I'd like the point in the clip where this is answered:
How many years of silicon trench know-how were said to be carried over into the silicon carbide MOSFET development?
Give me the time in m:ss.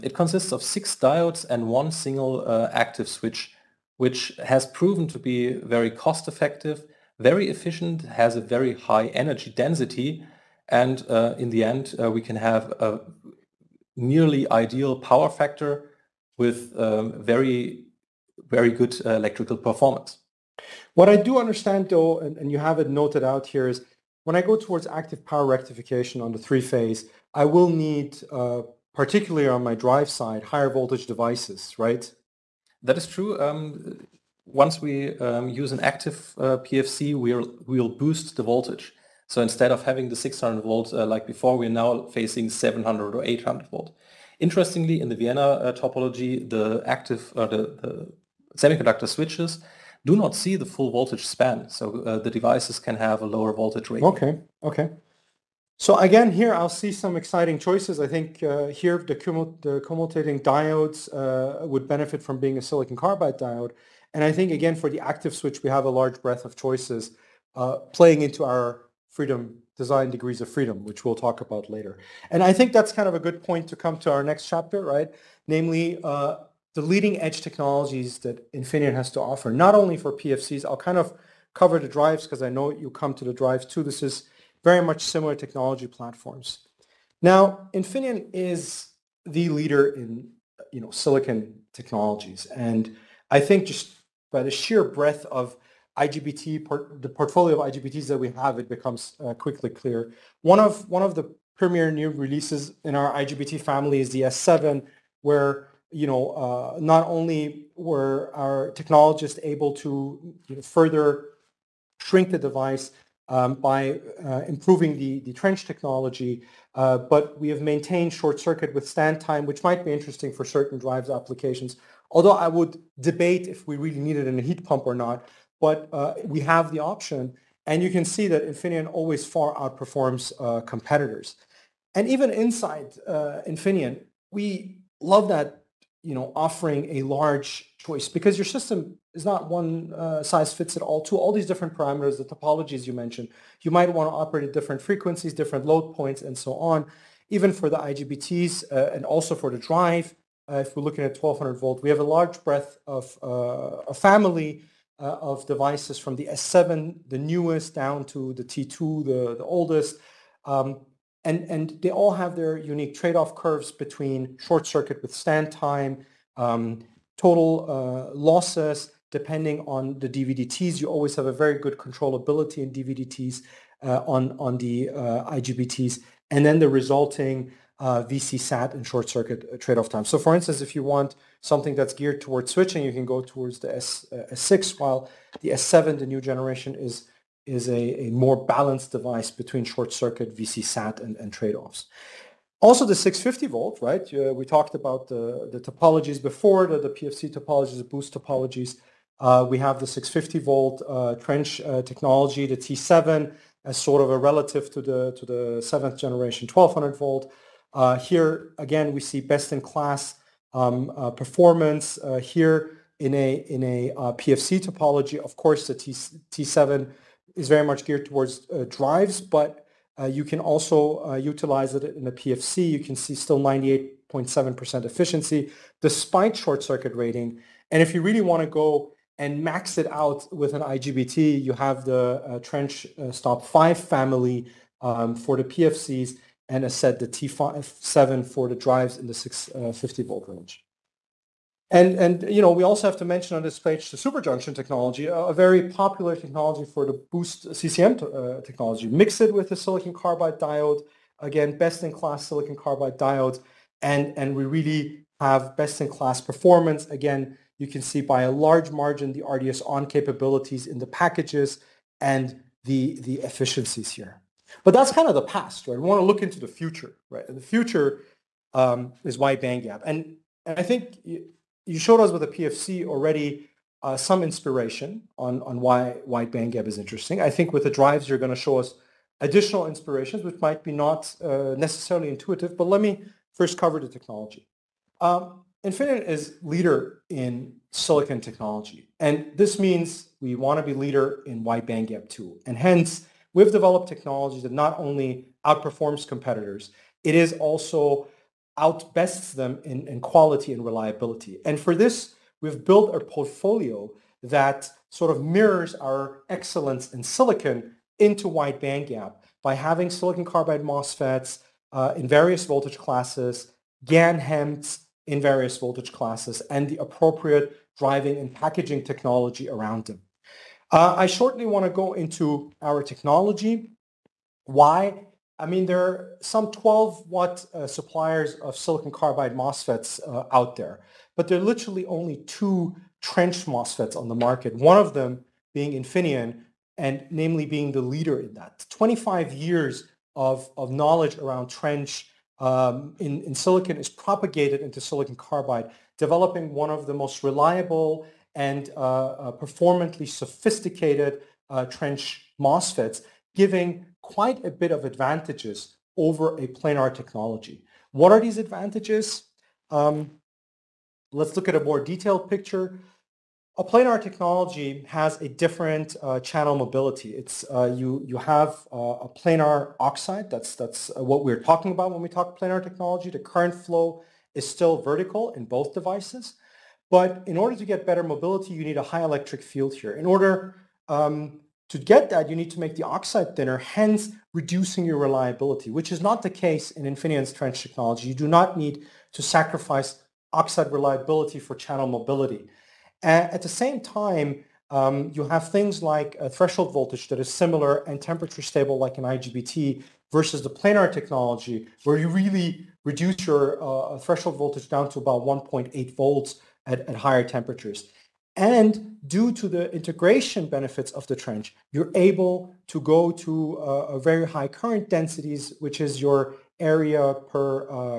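5:38.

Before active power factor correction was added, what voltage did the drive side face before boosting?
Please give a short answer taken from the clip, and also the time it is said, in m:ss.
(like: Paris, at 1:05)
600 volts, at 0:40.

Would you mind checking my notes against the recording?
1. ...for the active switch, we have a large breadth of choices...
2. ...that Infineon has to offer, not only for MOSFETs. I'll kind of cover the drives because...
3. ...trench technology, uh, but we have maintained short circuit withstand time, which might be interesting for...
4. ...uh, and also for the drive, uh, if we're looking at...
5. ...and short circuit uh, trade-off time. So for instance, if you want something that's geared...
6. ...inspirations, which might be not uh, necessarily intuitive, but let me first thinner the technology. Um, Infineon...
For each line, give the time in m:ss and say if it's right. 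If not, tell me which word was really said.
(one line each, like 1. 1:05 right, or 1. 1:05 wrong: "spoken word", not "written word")
1. 1:04 right
2. 1:18 wrong: "PFCs", not "MOSFETs"
3. 1:55 right
4. 2:28 right
5. 2:58 right
6. 4:39 wrong: "cover", not "thinner".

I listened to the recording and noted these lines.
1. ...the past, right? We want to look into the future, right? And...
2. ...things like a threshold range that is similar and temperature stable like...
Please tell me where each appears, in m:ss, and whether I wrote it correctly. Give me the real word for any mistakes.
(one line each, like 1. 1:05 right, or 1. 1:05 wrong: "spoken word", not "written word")
1. 4:25 right
2. 6:35 wrong: "voltage", not "range".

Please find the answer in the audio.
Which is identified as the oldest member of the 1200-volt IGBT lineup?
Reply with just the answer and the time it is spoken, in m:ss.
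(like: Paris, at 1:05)
T2, at 2:38.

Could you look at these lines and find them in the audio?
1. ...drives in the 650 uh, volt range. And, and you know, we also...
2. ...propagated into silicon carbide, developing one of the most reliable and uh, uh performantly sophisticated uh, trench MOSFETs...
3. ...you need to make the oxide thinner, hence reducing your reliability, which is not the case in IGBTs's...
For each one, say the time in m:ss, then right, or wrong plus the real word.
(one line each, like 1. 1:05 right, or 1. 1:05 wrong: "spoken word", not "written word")
1. 3:58 right
2. 5:43 right
3. 6:22 wrong: "Infineon", not "IGBTs".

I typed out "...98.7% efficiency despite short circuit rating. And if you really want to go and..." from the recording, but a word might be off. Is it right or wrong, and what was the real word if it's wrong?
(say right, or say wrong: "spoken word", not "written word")
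right.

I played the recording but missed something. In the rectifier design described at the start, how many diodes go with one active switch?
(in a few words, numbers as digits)
6.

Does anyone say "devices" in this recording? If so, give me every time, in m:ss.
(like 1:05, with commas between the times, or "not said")
0:31, 0:52, 1:52, 2:35, 3:08, 6:15.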